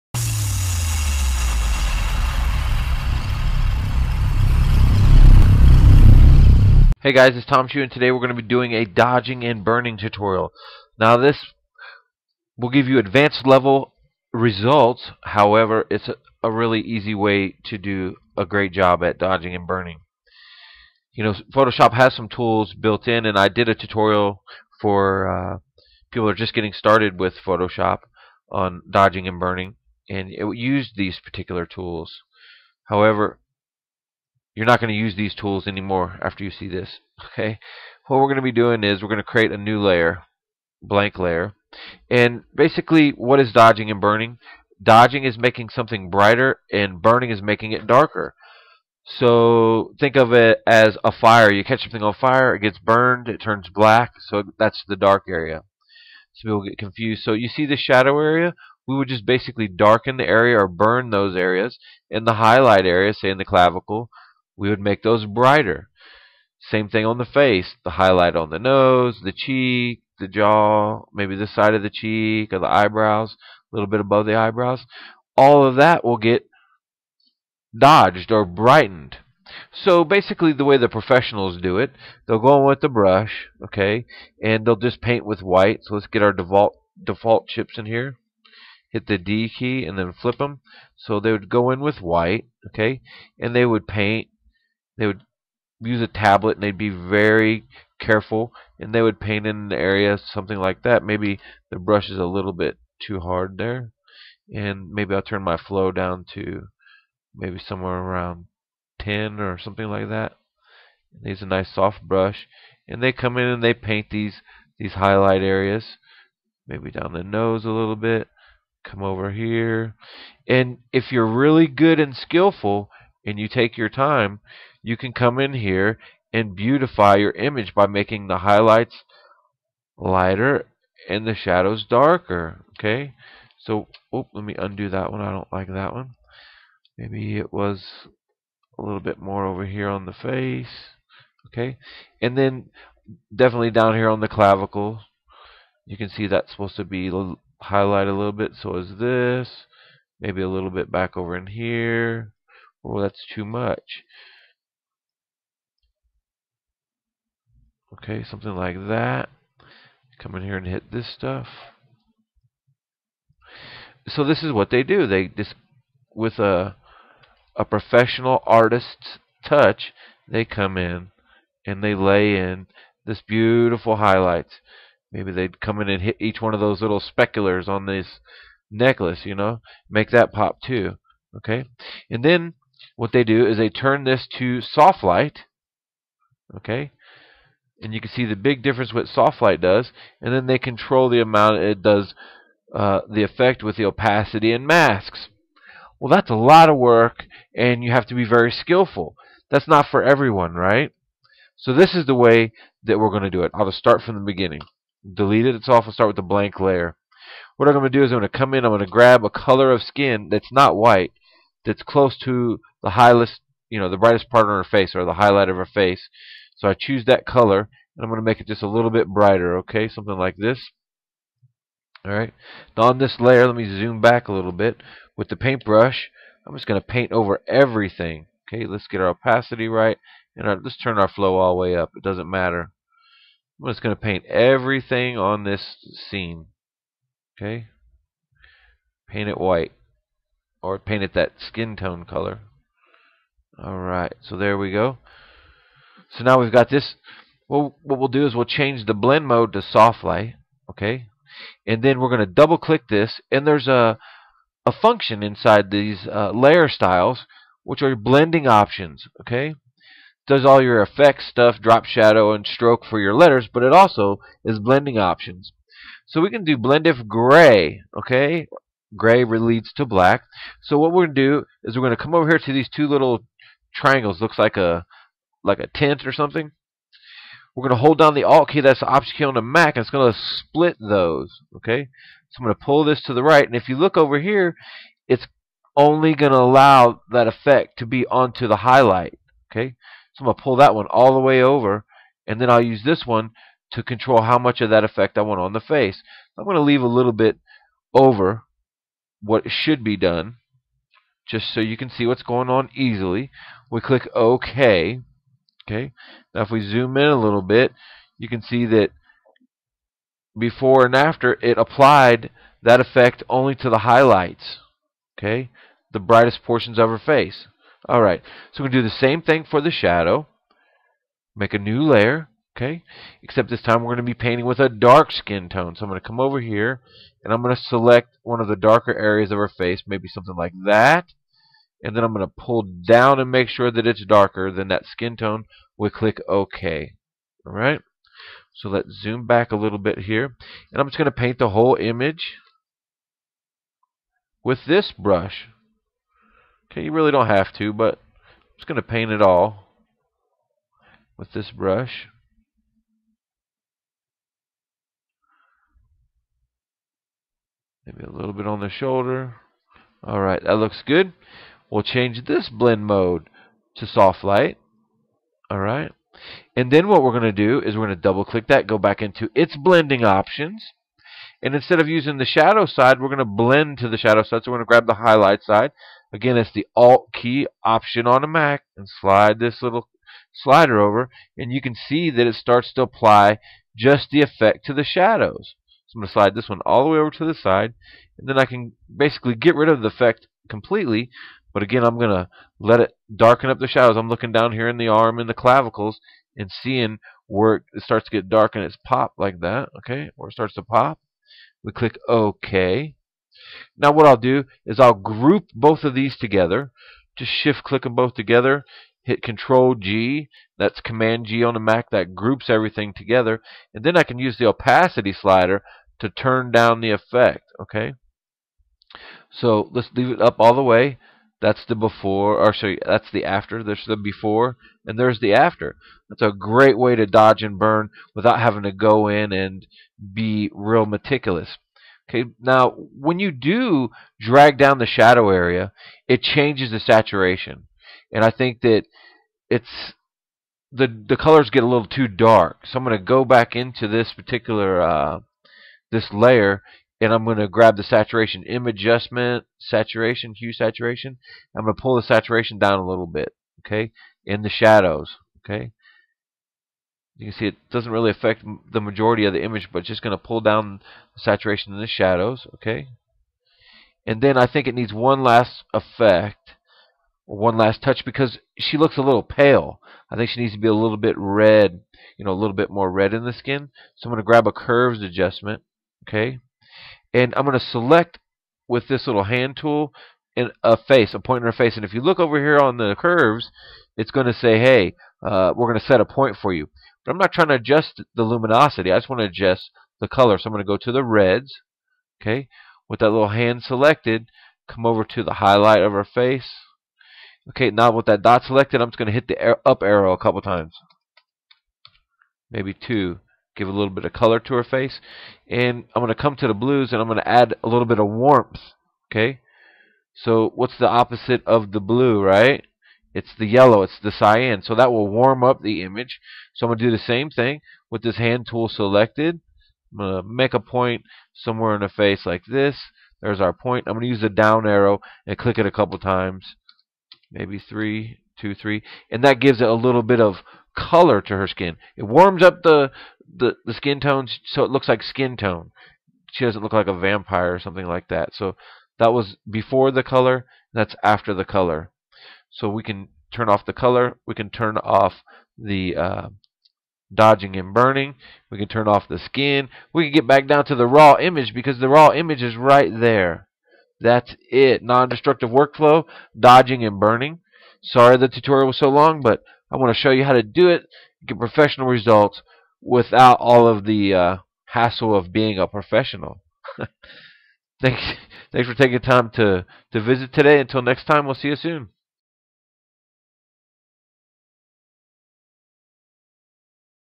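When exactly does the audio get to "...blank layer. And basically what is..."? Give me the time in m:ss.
0:40.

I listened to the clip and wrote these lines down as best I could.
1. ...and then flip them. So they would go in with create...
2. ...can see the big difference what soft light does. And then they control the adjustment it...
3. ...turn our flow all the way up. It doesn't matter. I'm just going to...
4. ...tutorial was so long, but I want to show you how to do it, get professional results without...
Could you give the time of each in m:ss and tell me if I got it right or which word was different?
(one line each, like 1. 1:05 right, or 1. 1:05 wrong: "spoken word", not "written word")
1. 1:29 wrong: "white", not "create"
2. 3:08 wrong: "amount", not "adjustment"
3. 3:50 right
4. 9:18 right.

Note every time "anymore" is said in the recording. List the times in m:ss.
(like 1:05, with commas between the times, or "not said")
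0:35.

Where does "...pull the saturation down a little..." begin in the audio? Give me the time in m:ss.
7:31.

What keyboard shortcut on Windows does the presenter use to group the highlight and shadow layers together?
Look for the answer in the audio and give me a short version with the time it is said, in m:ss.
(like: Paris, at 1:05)
Control G, at 6:49.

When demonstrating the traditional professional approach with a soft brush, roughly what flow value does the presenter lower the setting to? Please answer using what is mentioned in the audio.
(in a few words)
10.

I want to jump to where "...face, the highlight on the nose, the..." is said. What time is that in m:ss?
1:07.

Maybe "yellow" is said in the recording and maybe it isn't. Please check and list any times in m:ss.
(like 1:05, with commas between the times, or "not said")
8:33.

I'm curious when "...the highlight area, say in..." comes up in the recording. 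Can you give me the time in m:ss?
1:02.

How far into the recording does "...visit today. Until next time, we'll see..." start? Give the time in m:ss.
9:30.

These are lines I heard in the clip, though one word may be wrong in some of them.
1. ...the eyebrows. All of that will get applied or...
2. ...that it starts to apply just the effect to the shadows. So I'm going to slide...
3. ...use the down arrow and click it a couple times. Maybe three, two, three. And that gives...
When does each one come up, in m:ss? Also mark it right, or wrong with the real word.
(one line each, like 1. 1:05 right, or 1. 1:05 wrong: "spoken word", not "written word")
1. 1:14 wrong: "dodged", not "applied"
2. 6:22 right
3. 8:44 right.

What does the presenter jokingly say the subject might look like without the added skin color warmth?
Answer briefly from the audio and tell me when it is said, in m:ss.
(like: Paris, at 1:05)
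A vampire, at 8:56.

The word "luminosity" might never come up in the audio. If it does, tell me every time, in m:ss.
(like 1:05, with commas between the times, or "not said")
8:08.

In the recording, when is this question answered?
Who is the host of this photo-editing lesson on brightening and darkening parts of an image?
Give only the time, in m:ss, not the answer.
0:07.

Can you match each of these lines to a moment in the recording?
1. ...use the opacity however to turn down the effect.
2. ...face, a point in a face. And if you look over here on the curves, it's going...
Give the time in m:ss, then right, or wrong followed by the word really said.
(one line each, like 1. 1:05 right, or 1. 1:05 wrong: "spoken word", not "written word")
1. 6:54 wrong: "slider", not "however"
2. 8:00 right.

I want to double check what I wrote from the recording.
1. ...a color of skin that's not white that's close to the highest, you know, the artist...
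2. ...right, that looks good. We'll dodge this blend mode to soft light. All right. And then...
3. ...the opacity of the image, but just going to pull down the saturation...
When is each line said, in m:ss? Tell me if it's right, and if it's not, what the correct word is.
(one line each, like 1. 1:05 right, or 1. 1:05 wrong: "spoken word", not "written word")
1. 3:29 wrong: "brightest", not "artist"
2. 6:00 wrong: "change", not "dodge"
3. 7:38 wrong: "majority", not "opacity".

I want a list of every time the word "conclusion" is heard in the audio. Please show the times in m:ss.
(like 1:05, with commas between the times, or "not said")
not said.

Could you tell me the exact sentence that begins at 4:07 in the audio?
Well, what we'll do is we'll change the blend mode to soft light, okay?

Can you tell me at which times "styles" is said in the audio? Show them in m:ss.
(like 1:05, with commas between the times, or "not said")
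4:16.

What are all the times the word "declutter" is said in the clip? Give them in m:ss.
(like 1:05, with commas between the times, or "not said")
not said.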